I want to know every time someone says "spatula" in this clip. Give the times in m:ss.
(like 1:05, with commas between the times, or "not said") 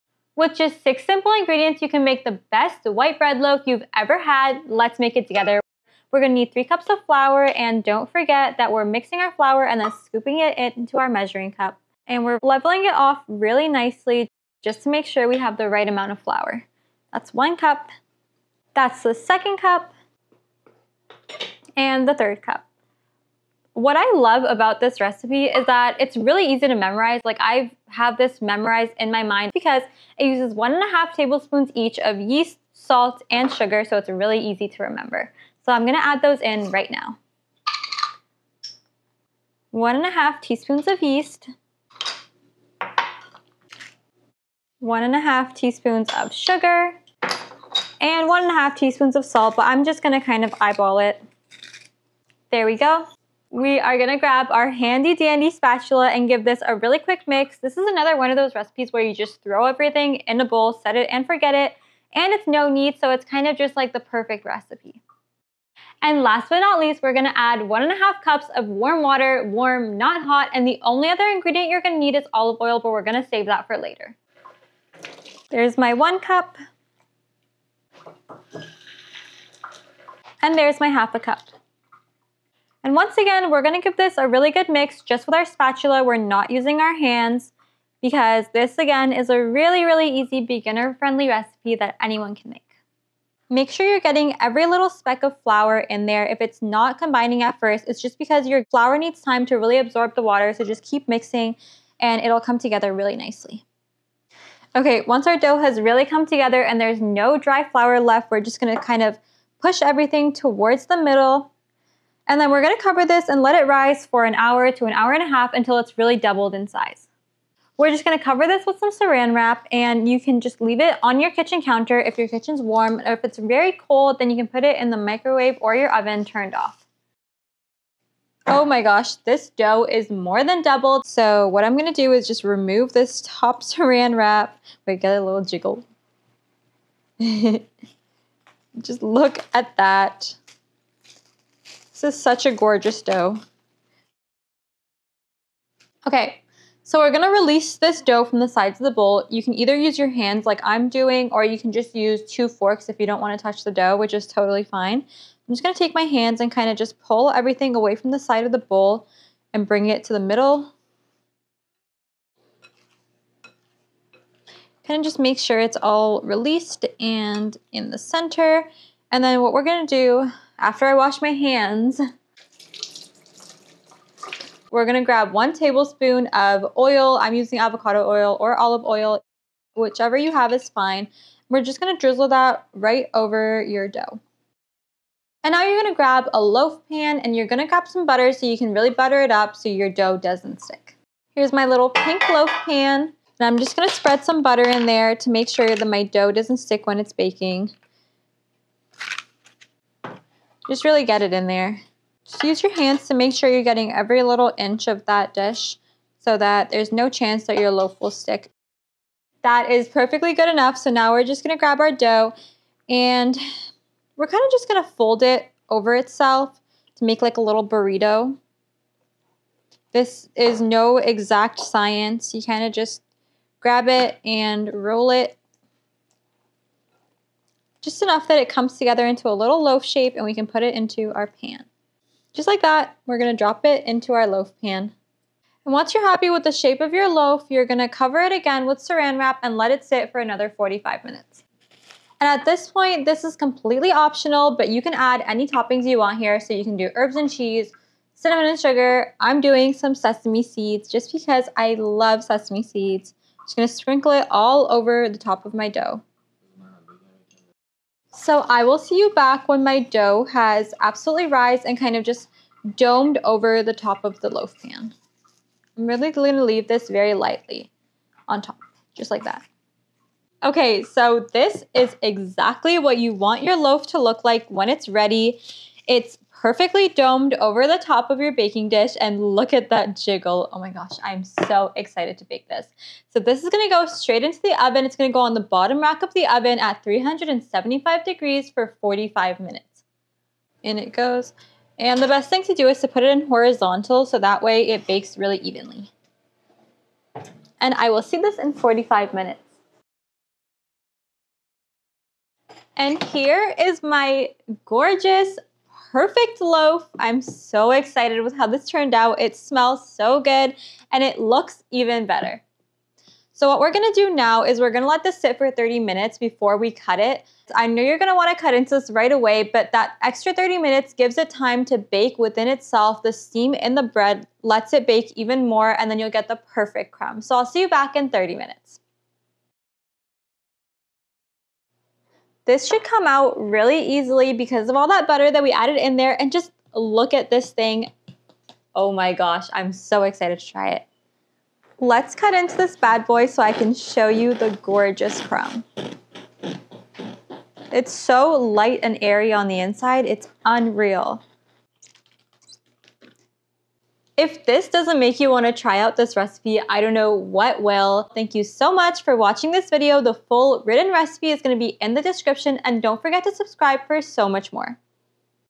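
0:55, 1:25.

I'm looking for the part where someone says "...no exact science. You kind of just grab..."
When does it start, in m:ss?
3:40.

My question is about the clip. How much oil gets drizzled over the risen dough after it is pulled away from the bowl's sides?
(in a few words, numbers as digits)
1 tablespoon.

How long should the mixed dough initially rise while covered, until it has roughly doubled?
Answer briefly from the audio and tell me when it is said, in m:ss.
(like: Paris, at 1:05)
an hour to an hour and a half, at 1:54.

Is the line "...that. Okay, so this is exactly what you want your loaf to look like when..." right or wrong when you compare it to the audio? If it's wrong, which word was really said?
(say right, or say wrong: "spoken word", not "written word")
right.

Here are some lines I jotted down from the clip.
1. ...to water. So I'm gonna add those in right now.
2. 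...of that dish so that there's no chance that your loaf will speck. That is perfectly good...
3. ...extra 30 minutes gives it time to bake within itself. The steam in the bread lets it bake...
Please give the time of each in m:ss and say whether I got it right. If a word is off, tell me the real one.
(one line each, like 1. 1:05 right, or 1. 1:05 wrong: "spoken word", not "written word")
1. 0:34 wrong: "remember", not "water"
2. 3:24 wrong: "stick", not "speck"
3. 5:20 right.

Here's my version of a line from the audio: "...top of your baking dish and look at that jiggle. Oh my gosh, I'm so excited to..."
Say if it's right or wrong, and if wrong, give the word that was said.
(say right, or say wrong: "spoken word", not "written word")
right.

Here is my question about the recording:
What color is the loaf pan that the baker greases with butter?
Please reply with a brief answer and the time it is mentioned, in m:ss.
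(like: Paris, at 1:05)
pink, at 3:11.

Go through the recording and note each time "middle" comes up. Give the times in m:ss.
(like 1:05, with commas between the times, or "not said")
1:50, 2:40.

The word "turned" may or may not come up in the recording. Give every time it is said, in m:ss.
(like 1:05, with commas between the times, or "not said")
2:06, 5:08.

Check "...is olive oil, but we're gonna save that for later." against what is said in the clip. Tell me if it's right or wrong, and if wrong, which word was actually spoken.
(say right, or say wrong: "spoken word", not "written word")
right.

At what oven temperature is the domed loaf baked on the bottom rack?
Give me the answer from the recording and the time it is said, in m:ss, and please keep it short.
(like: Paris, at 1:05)
375 degrees, at 4:46.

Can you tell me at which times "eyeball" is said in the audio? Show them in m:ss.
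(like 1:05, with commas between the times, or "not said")
0:50.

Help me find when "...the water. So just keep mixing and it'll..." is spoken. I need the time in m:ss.
1:40.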